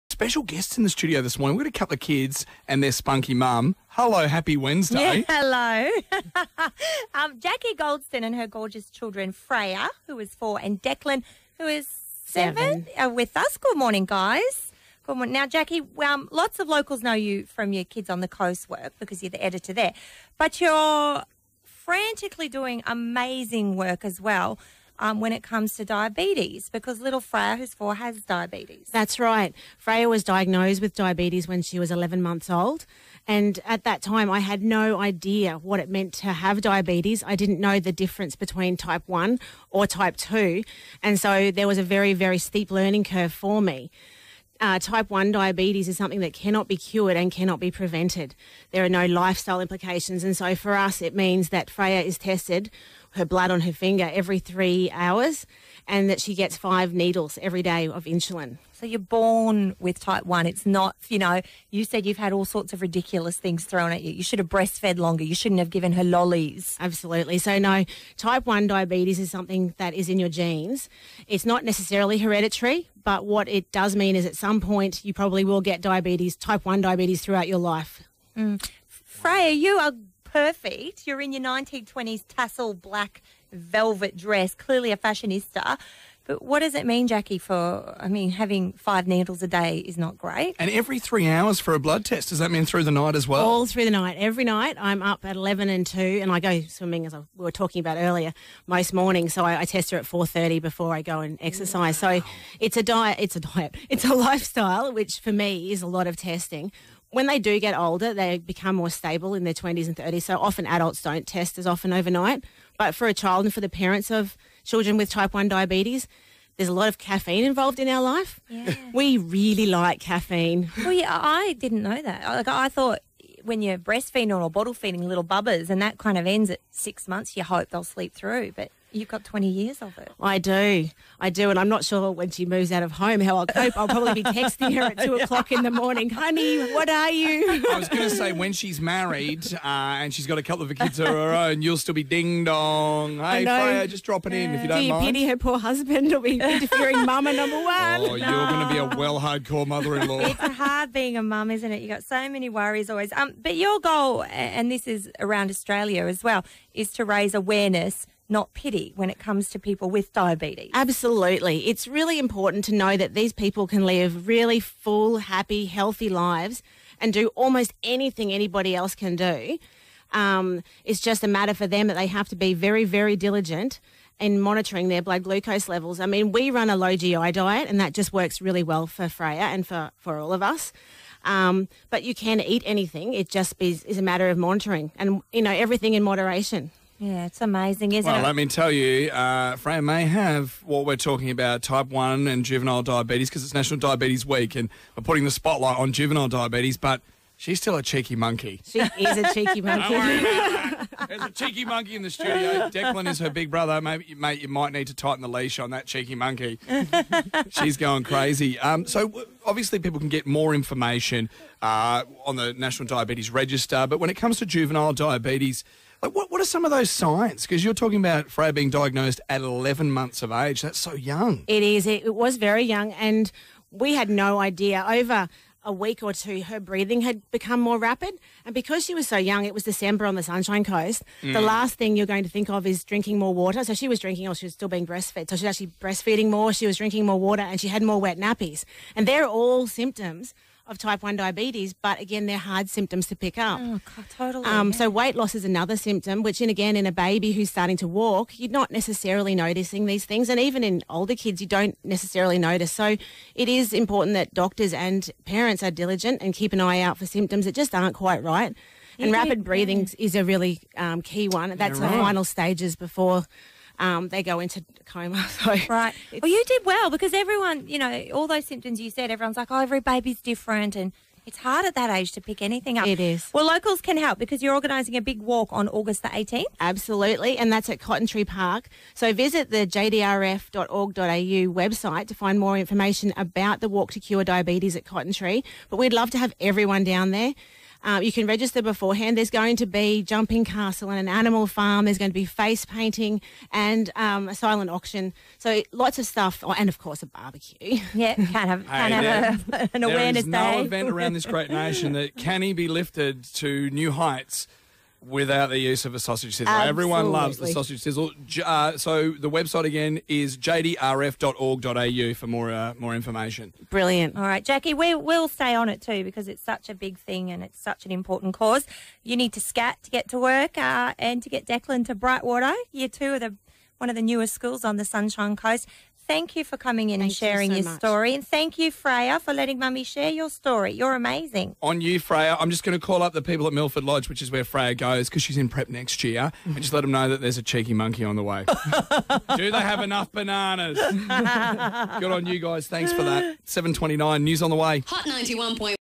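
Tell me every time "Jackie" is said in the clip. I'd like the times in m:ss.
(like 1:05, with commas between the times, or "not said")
0:07, 0:15, 1:27, 5:14.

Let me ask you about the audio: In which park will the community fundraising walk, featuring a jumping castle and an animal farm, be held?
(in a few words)
Cotton Tree Park.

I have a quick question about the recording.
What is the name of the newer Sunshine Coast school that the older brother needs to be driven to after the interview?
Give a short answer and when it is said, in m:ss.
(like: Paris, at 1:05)
Brightwater, at 5:21.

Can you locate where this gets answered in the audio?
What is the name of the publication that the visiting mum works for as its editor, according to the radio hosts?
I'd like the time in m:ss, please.
0:17.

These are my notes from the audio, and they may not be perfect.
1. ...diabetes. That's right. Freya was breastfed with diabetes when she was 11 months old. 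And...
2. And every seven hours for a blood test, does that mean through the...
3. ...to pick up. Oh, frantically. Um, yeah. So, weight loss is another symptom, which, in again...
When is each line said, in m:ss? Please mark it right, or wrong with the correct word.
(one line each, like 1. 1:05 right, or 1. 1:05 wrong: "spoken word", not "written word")
1. 0:28 wrong: "diagnosed", not "breastfed"
2. 1:30 wrong: "three", not "seven"
3. 4:03 wrong: "totally", not "frantically".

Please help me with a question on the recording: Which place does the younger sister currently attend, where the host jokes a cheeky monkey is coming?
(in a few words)
Milford Lodge.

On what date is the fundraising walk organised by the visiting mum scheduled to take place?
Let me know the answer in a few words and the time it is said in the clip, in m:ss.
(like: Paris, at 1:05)
August 18, at 4:35.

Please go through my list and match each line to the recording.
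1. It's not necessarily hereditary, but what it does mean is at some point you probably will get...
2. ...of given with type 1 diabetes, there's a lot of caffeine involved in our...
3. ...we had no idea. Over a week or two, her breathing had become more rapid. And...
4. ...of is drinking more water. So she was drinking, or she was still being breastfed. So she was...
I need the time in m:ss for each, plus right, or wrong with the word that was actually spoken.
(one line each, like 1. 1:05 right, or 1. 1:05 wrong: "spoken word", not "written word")
1. 1:11 right
2. 1:54 wrong: "children", not "given"
3. 3:43 right
4. 3:52 right.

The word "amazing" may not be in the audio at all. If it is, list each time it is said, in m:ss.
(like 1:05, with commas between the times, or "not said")
0:22, 3:07, 5:30.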